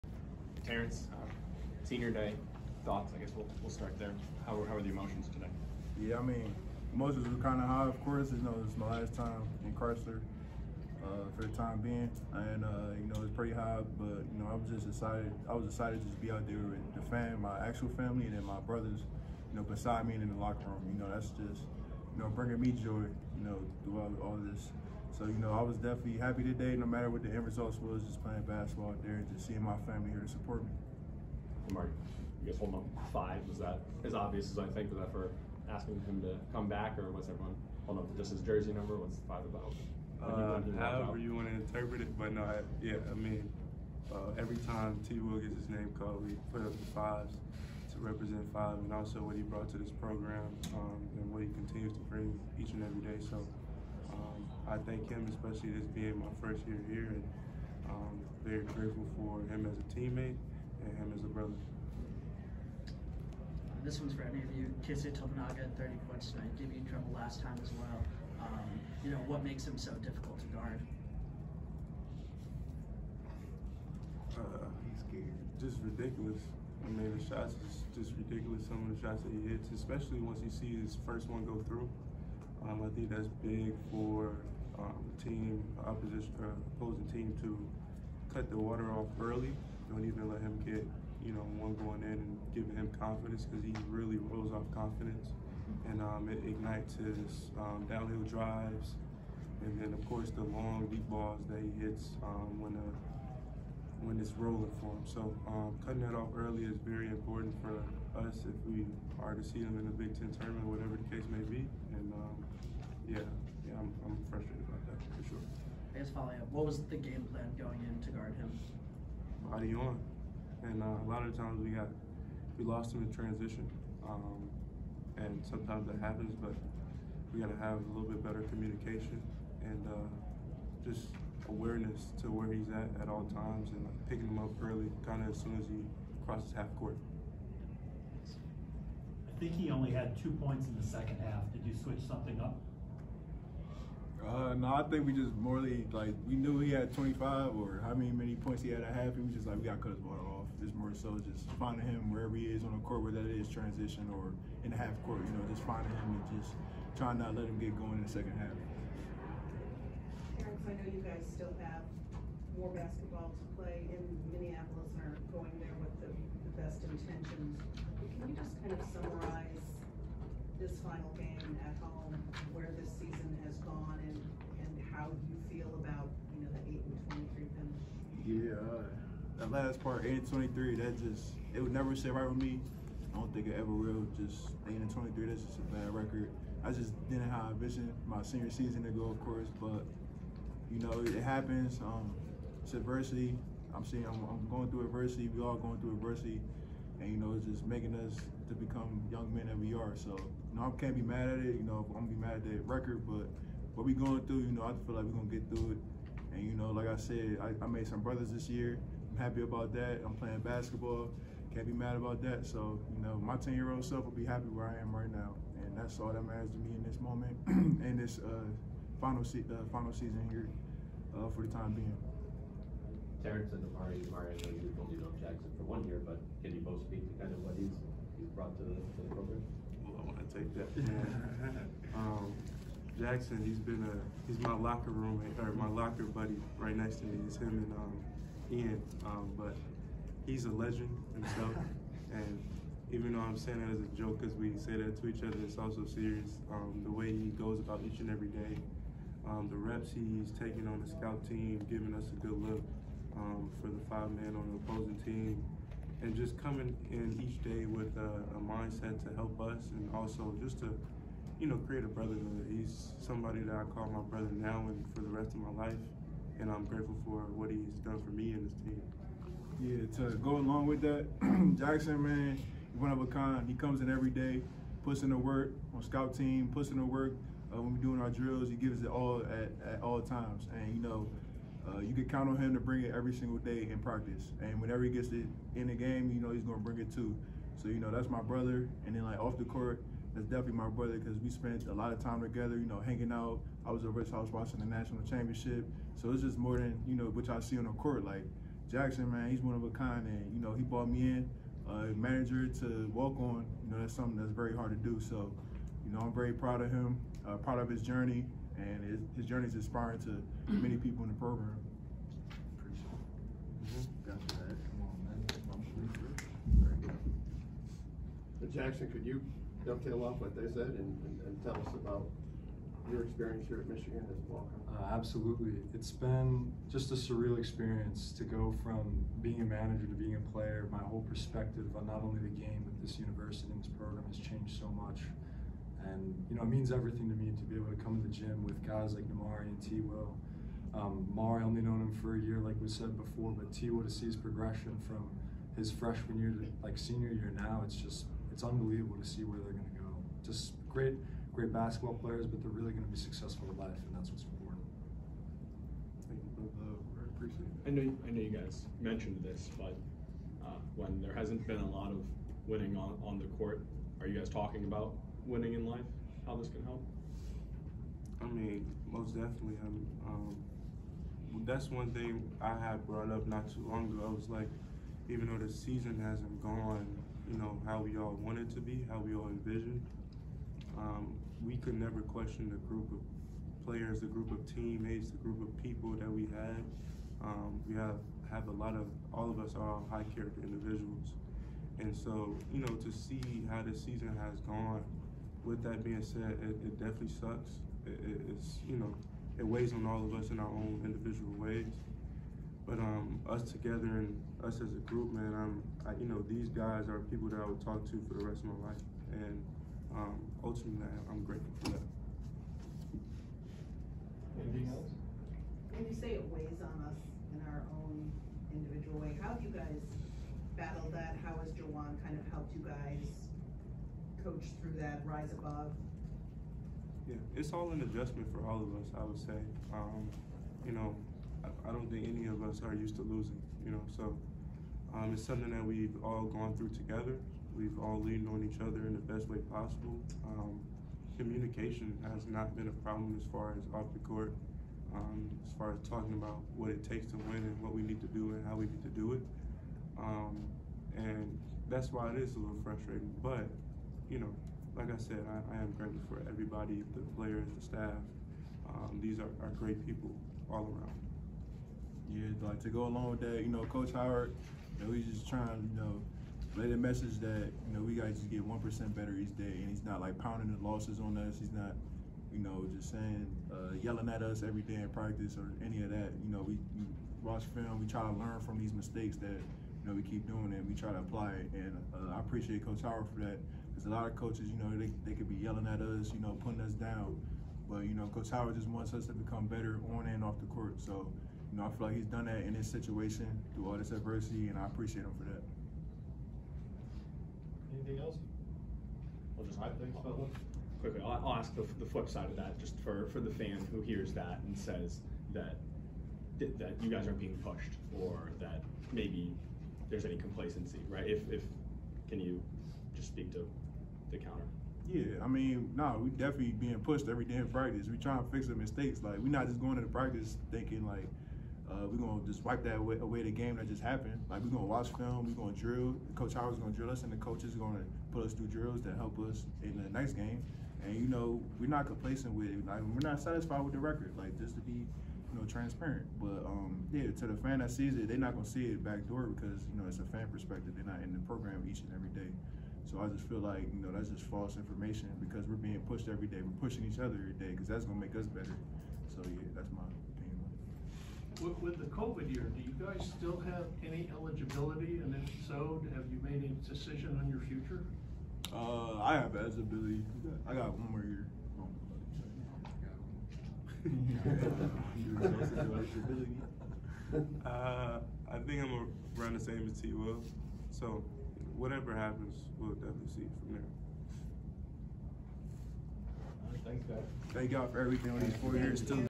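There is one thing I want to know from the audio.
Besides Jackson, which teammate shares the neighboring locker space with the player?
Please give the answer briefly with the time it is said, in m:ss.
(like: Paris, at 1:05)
Ian, at 3:58.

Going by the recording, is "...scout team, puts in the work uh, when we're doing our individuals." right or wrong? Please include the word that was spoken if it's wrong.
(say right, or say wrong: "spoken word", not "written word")
wrong: "drills", not "individuals".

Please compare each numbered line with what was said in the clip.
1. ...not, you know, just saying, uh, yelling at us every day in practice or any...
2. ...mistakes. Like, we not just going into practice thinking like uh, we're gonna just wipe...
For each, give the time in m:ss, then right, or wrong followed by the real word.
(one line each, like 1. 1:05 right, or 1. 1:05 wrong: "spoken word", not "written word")
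1. 7:51 right
2. 8:38 right.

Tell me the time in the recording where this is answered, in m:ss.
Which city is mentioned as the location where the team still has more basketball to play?
2:44.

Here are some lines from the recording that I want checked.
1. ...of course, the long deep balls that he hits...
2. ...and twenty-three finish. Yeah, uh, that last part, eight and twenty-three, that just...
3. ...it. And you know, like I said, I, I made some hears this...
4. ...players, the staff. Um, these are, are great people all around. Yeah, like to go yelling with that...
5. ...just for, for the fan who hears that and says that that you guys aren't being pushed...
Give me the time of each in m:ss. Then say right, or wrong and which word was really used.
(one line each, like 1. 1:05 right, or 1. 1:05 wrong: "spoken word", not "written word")
1. 1:39 right
2. 2:56 right
3. 3:25 wrong: "brothers", not "hears"
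4. 7:37 wrong: "along", not "yelling"
5. 8:22 right.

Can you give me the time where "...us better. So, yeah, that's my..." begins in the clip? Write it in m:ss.
9:08.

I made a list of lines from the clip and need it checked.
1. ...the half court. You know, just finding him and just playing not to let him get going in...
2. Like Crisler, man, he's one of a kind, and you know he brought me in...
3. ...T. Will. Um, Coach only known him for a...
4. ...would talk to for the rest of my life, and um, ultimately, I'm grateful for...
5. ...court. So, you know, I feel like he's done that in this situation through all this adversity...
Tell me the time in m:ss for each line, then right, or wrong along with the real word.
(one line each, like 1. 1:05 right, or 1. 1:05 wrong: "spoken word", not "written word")
1. 2:34 wrong: "trying", not "playing"
2. 4:58 wrong: "Jackson", not "Crisler"
3. 5:39 wrong: "Mari", not "Coach"
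4. 6:47 right
5. 8:10 right.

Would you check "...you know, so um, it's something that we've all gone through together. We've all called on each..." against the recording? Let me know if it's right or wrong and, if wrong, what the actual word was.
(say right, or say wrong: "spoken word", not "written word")
wrong: "leaned", not "called".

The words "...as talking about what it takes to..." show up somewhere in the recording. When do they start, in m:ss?
7:25.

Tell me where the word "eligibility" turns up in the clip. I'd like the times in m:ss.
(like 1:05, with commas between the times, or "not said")
9:14, 9:19.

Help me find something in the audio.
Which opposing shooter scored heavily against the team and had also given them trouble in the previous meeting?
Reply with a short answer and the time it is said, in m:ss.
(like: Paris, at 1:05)
Keisei Tominaga, at 1:04.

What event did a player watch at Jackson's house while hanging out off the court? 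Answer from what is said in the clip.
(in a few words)
national championship.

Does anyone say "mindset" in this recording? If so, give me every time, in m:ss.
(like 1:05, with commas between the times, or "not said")
4:18.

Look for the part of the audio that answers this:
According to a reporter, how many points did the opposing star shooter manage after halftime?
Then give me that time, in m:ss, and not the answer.
2:20.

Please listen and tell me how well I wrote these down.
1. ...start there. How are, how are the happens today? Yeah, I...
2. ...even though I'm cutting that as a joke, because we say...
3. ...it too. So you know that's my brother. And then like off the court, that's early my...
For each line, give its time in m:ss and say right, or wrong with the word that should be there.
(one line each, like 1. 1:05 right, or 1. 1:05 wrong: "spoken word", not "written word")
1. 0:03 wrong: "emotions", not "happens"
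2. 4:02 wrong: "saying", not "cutting"
3. 4:46 wrong: "definitely", not "early".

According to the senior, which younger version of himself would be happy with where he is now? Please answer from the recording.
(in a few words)
10 year old self.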